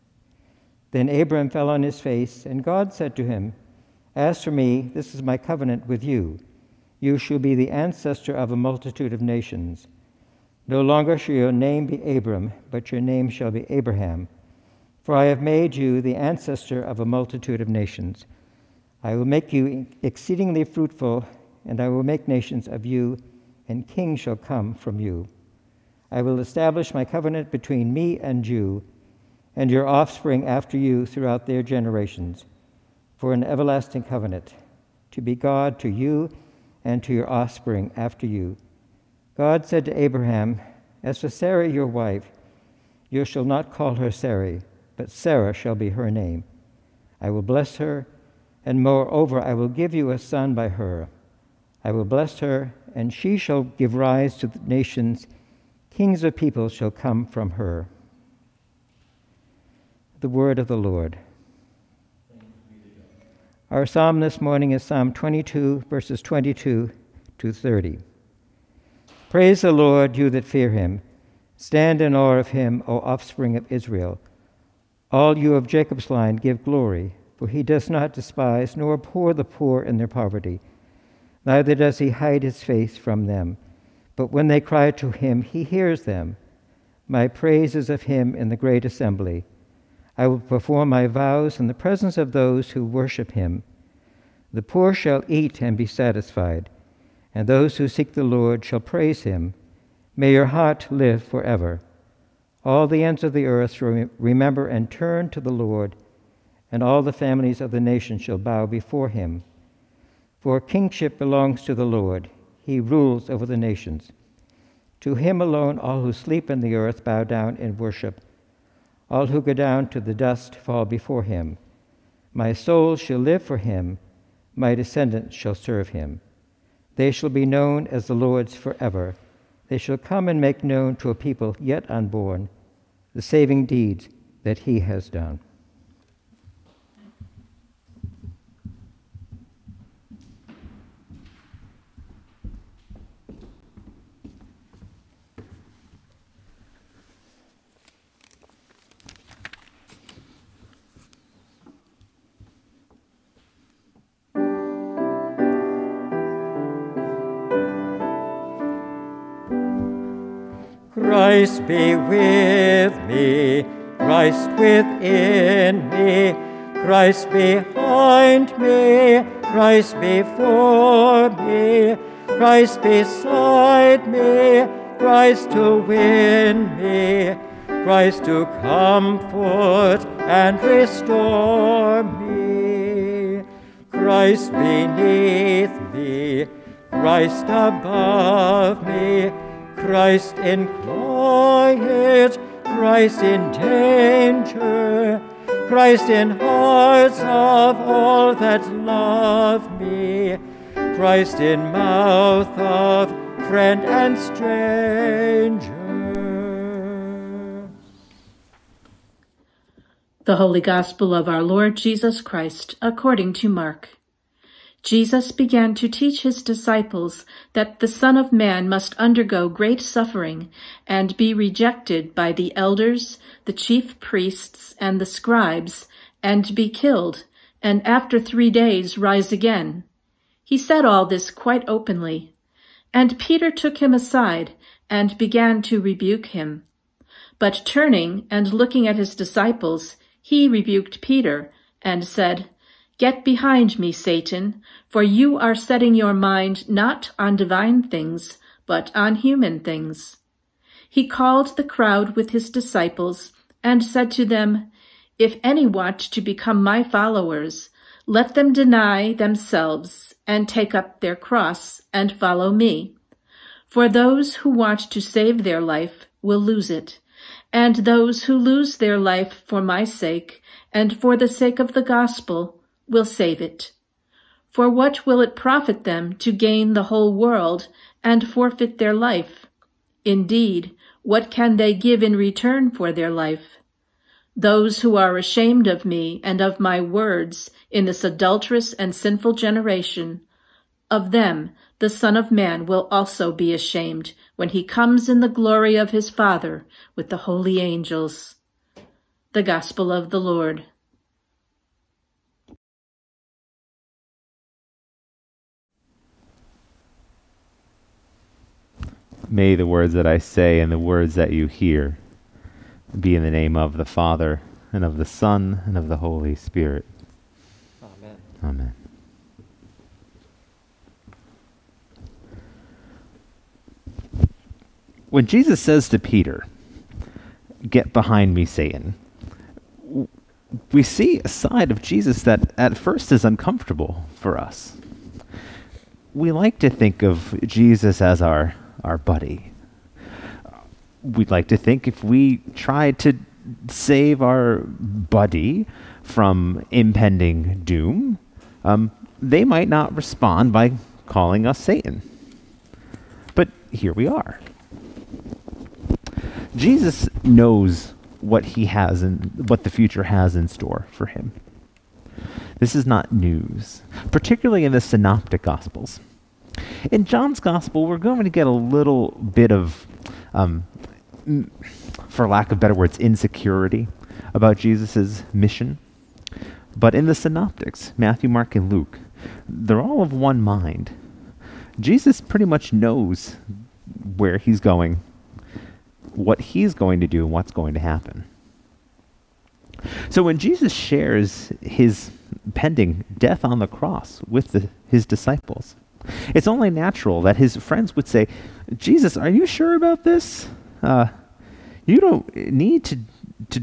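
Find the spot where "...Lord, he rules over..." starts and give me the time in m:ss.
1:51.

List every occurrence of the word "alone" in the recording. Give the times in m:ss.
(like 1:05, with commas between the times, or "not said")
1:55.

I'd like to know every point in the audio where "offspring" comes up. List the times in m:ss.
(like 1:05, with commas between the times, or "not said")
0:29, 0:37, 1:13.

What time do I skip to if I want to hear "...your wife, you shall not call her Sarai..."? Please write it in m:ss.
0:41.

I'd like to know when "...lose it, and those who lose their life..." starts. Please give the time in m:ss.
4:26.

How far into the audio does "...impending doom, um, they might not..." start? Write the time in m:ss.
5:46.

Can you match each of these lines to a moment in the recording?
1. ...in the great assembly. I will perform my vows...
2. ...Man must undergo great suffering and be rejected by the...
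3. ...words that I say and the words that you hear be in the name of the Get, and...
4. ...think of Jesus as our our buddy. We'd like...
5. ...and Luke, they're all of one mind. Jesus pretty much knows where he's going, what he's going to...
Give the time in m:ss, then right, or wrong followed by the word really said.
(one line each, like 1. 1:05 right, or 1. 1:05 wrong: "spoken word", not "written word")
1. 1:28 right
2. 3:38 right
3. 5:09 wrong: "Father", not "Get"
4. 5:36 right
5. 6:18 right.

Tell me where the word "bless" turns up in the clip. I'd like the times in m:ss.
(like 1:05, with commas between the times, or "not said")
0:47, 0:52.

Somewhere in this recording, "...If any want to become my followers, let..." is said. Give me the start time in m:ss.
4:15.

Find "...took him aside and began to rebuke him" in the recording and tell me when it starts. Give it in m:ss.
3:53.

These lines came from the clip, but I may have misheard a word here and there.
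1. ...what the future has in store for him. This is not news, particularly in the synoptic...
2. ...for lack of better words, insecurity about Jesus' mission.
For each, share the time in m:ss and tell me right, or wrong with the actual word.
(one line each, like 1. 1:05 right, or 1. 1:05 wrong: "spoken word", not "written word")
1. 5:59 right
2. 6:12 right.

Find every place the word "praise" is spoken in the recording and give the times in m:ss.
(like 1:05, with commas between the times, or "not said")
1:09, 1:27, 1:38.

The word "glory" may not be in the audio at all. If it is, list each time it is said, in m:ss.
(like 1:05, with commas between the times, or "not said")
1:16, 4:55.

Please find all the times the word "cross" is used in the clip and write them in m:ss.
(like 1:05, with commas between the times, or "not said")
4:21, 6:33.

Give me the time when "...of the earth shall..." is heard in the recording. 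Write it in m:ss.
1:43.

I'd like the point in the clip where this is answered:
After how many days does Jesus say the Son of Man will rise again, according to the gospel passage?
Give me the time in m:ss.
3:48.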